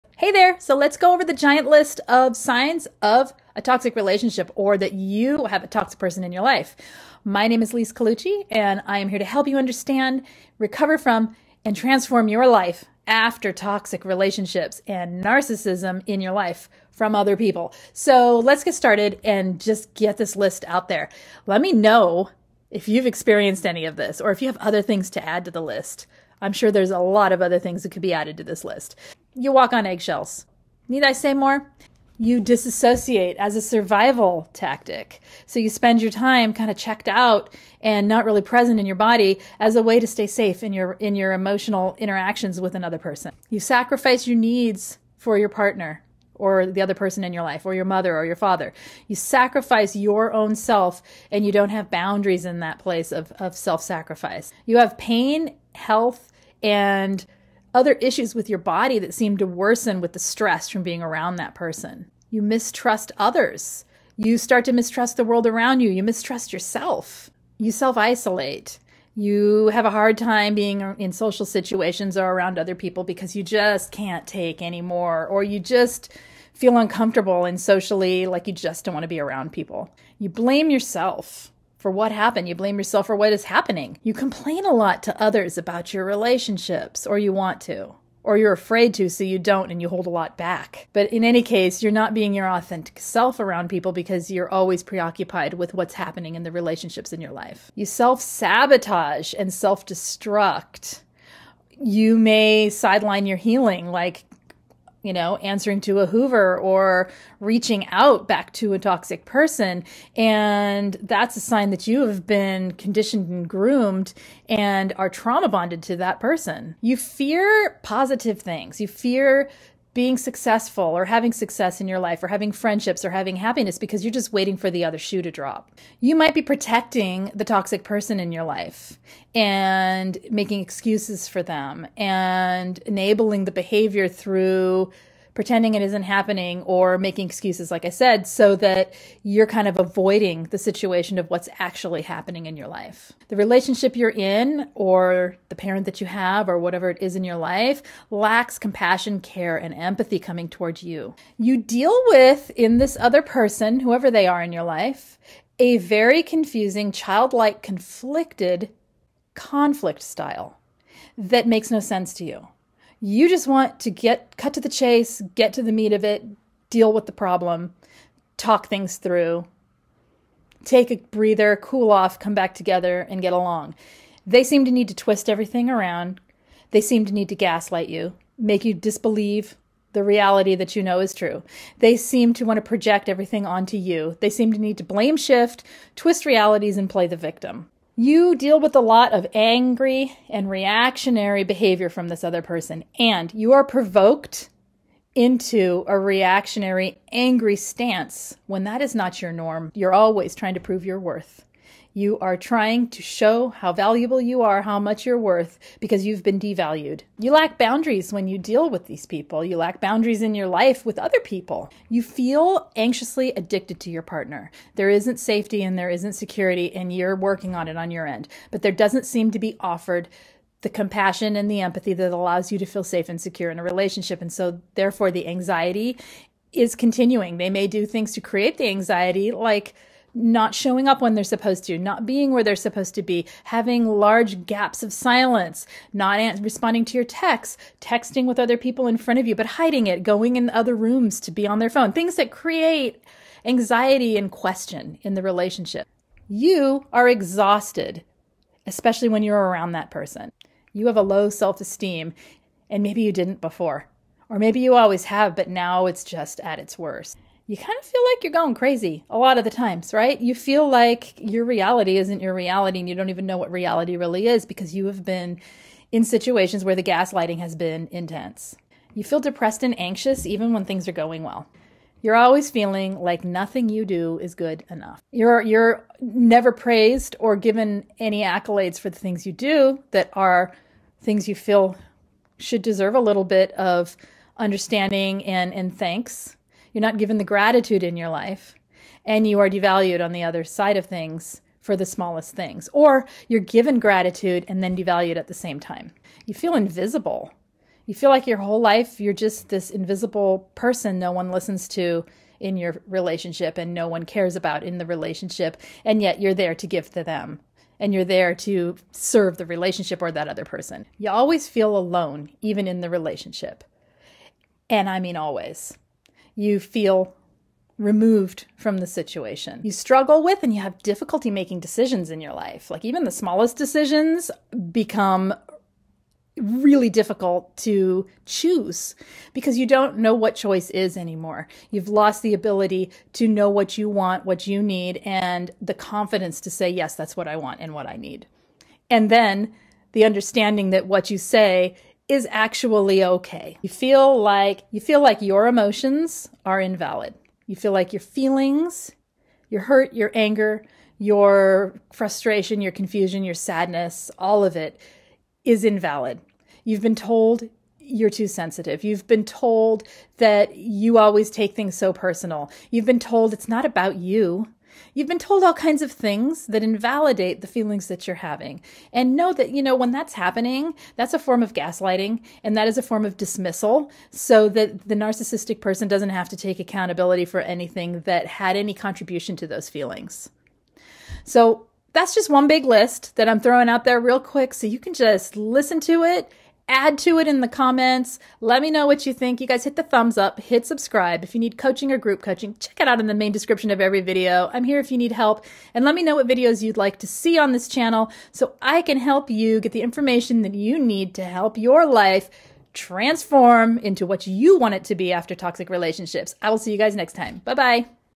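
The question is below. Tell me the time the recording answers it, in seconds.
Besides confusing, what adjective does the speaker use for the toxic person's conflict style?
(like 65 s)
156 s.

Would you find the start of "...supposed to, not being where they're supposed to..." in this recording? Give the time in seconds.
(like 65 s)
231 s.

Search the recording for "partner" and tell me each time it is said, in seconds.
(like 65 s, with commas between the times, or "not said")
45 s, 214 s.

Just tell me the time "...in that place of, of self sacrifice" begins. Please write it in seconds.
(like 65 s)
52 s.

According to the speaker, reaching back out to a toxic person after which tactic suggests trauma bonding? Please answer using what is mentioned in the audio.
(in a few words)
a Hoover.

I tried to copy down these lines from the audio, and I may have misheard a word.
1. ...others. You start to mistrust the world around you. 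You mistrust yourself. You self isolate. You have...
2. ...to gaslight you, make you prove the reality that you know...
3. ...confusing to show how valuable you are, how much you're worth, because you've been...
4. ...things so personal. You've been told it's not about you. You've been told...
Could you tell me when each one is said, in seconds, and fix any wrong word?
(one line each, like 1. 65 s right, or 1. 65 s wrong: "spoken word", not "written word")
1. 63 s right
2. 177 s wrong: "disbelieve", not "prove"
3. 202 s wrong: "trying", not "confusing"
4. 361 s right.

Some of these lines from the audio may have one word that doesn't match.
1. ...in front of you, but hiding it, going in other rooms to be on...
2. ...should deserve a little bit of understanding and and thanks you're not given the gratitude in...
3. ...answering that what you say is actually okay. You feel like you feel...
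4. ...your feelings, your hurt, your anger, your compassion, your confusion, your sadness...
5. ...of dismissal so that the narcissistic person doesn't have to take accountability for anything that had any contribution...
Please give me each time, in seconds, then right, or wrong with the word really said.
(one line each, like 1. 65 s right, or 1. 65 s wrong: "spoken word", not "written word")
1. 238 s right
2. 282 s right
3. 340 s wrong: "understanding", not "answering"
4. 347 s wrong: "frustration", not "compassion"
5. 373 s right.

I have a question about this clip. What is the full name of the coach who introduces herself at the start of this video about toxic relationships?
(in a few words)
Lise Colucci.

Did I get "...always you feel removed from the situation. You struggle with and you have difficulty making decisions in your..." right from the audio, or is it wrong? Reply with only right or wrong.
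right.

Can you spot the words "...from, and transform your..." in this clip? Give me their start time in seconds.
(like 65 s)
10 s.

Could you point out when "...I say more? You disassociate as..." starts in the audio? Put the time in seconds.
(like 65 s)
31 s.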